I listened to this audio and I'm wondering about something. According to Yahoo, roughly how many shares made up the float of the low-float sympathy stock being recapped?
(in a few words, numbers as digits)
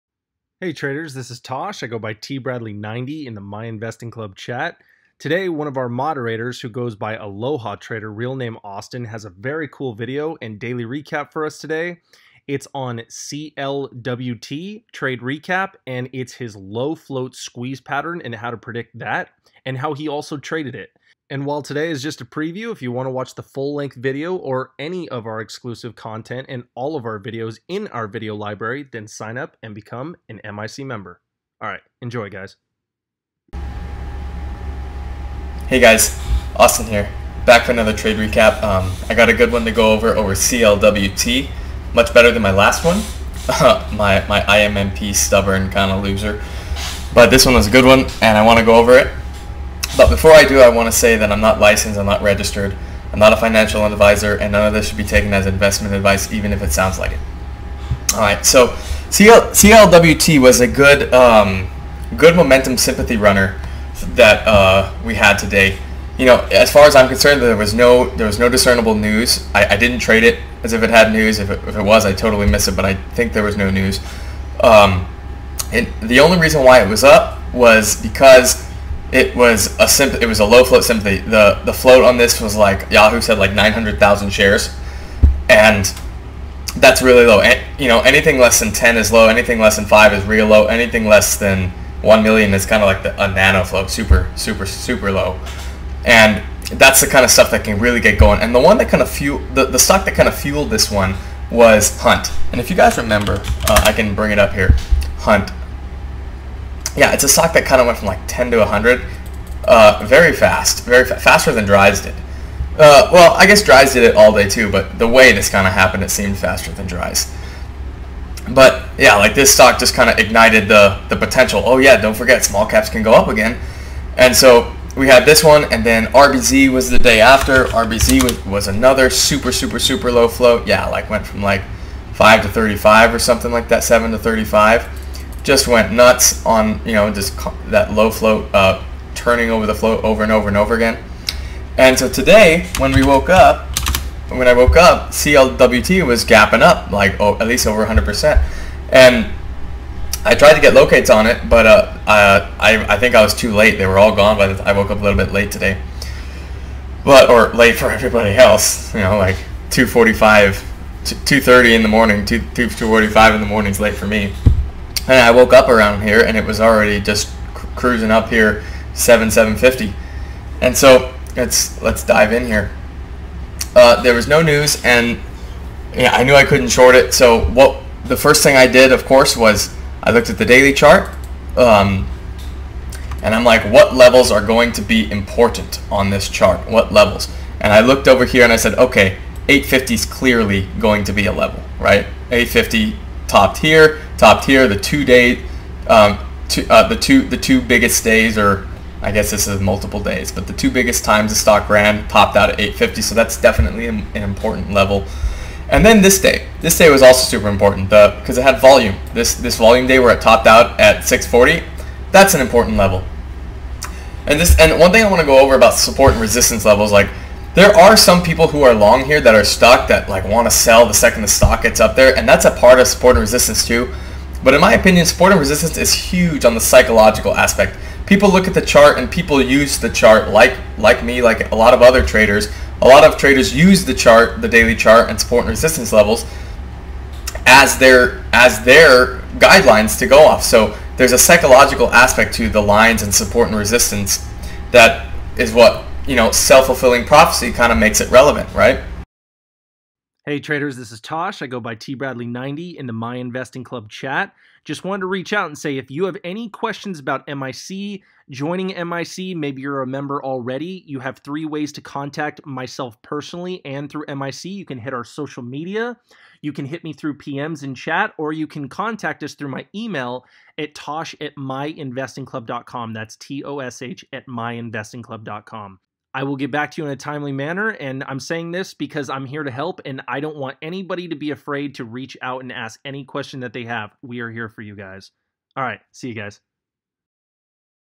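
900,000.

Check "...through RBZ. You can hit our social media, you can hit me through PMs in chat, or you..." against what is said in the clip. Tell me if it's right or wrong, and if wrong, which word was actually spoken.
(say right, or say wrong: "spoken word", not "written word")
wrong: "MIC", not "RBZ".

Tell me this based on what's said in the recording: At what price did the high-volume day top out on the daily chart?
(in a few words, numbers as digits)
640.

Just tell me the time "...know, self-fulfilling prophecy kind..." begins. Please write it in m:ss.
4:06.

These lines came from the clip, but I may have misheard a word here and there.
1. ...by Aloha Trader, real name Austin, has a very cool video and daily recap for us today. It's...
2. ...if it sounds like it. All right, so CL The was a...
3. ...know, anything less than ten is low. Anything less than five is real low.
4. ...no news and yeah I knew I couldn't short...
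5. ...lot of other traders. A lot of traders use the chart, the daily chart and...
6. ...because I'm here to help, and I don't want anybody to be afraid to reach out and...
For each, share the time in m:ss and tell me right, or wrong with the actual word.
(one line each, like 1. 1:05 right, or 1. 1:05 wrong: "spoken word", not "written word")
1. 0:06 right
2. 0:56 wrong: "CLWT", not "The"
3. 1:27 right
4. 2:54 right
5. 3:51 right
6. 4:38 right.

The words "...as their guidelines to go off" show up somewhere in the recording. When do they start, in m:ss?
3:58.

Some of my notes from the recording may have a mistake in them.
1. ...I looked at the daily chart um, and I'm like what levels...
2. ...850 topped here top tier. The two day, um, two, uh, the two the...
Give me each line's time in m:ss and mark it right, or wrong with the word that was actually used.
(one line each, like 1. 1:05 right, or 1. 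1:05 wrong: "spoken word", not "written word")
1. 3:00 right
2. 3:12 right.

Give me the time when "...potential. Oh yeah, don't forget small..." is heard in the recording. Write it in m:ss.
2:01.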